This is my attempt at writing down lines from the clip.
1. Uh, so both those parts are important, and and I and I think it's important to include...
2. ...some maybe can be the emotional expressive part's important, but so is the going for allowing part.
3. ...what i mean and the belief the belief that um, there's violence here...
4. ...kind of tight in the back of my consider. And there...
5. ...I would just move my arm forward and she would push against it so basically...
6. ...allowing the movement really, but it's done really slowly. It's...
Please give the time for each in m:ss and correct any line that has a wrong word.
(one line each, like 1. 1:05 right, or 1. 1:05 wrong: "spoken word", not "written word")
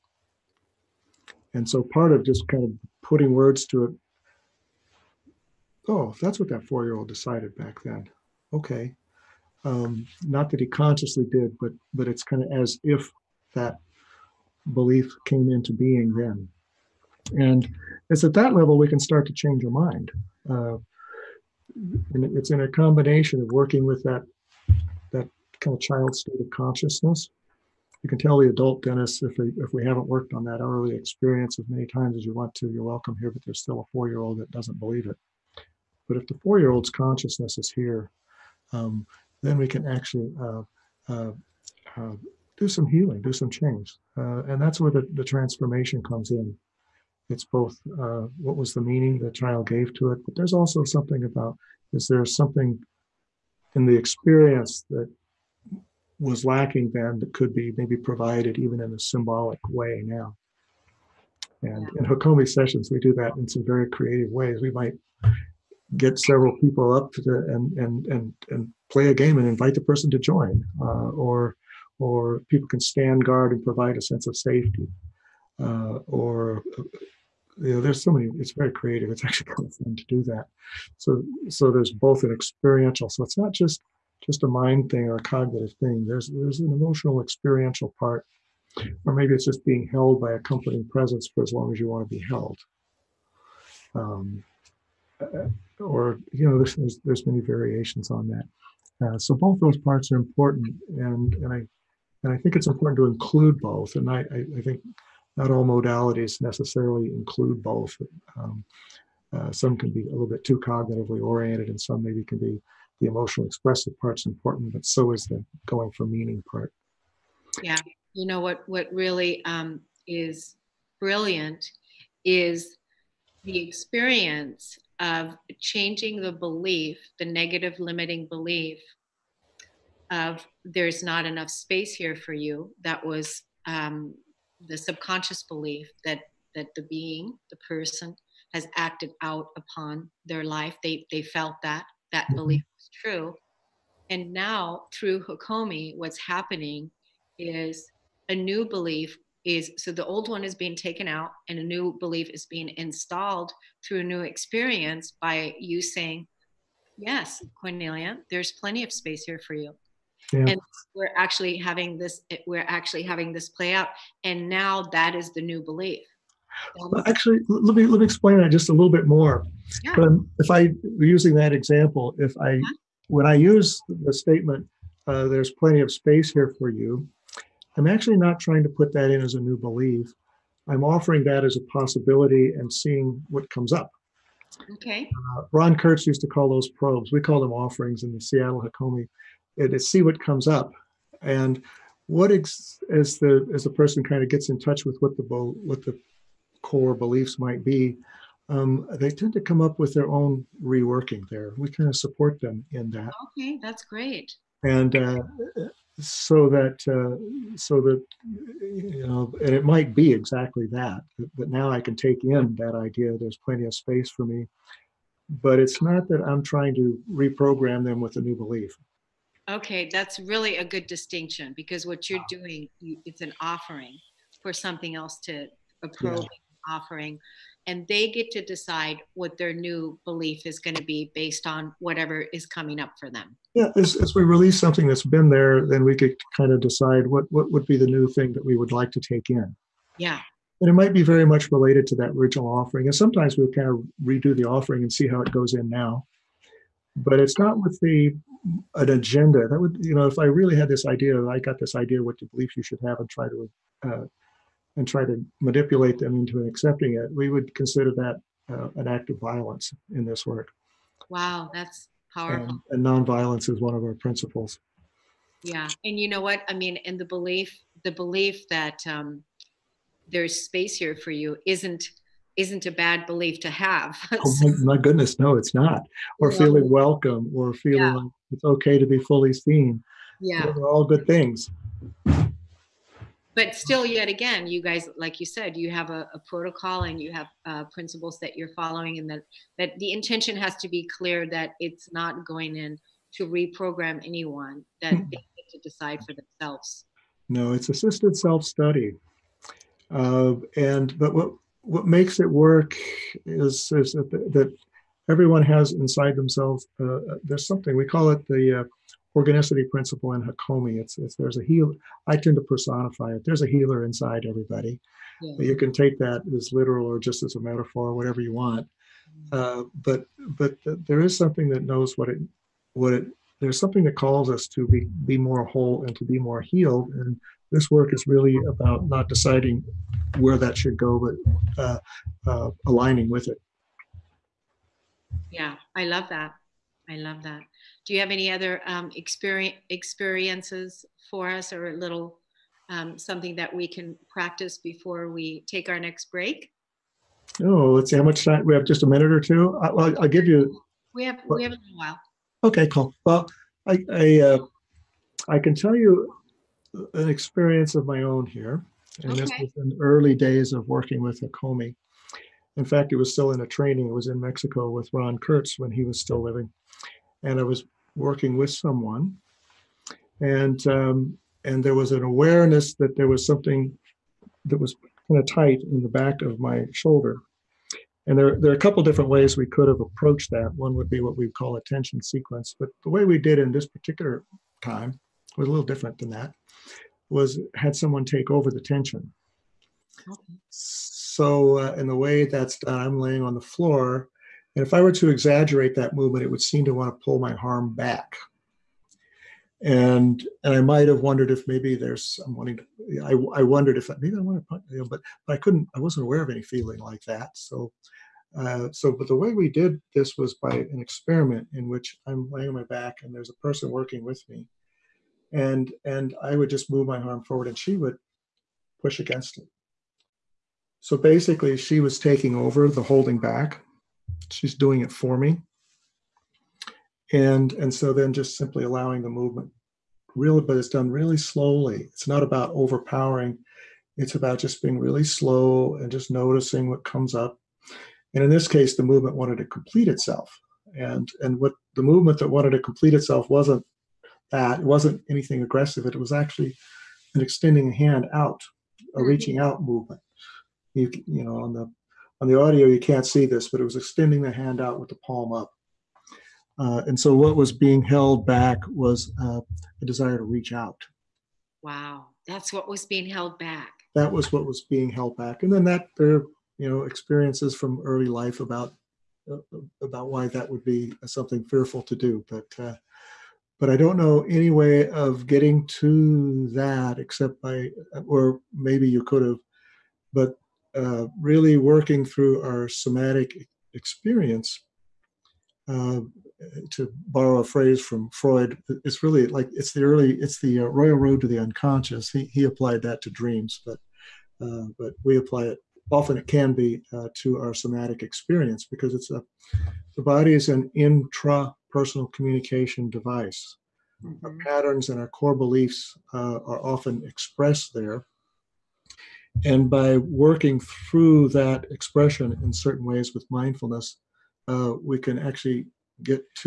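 1. 1:39 right
2. 1:51 wrong: "meaning", not "allowing"
3. 4:26 wrong: "space", not "violence"
4. 6:15 wrong: "shoulder", not "consider"
5. 6:56 right
6. 7:08 right.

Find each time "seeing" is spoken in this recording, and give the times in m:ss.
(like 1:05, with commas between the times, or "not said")
3:02.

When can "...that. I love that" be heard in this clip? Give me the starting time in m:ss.
5:36.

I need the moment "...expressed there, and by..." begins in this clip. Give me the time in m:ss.
8:27.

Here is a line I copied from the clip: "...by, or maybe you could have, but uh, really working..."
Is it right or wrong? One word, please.
right.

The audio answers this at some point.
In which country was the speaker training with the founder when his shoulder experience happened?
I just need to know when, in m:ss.
6:04.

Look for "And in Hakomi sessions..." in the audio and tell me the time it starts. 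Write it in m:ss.
1:01.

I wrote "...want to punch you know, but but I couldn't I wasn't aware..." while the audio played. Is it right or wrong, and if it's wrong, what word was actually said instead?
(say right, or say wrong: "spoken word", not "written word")
right.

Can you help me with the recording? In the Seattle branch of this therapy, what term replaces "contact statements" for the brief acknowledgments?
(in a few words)
offerings.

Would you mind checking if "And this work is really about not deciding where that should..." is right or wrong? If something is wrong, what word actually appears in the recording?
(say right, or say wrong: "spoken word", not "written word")
right.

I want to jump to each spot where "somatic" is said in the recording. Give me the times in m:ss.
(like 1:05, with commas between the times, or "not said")
8:02, 8:17.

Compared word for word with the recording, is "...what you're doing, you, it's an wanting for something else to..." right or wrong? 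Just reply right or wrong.
wrong.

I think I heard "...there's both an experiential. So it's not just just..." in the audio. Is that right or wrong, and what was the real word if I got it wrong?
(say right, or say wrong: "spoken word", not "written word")
right.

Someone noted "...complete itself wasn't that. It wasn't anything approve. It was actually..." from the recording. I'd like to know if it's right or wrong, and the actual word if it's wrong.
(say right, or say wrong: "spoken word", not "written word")
wrong: "aggressive", not "approve".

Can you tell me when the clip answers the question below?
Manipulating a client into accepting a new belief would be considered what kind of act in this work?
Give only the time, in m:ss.
4:18.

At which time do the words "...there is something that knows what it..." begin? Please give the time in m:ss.
5:20.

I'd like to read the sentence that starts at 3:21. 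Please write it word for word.
There, we kind of support them in that.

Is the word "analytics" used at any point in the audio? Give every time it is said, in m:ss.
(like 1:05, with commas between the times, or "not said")
not said.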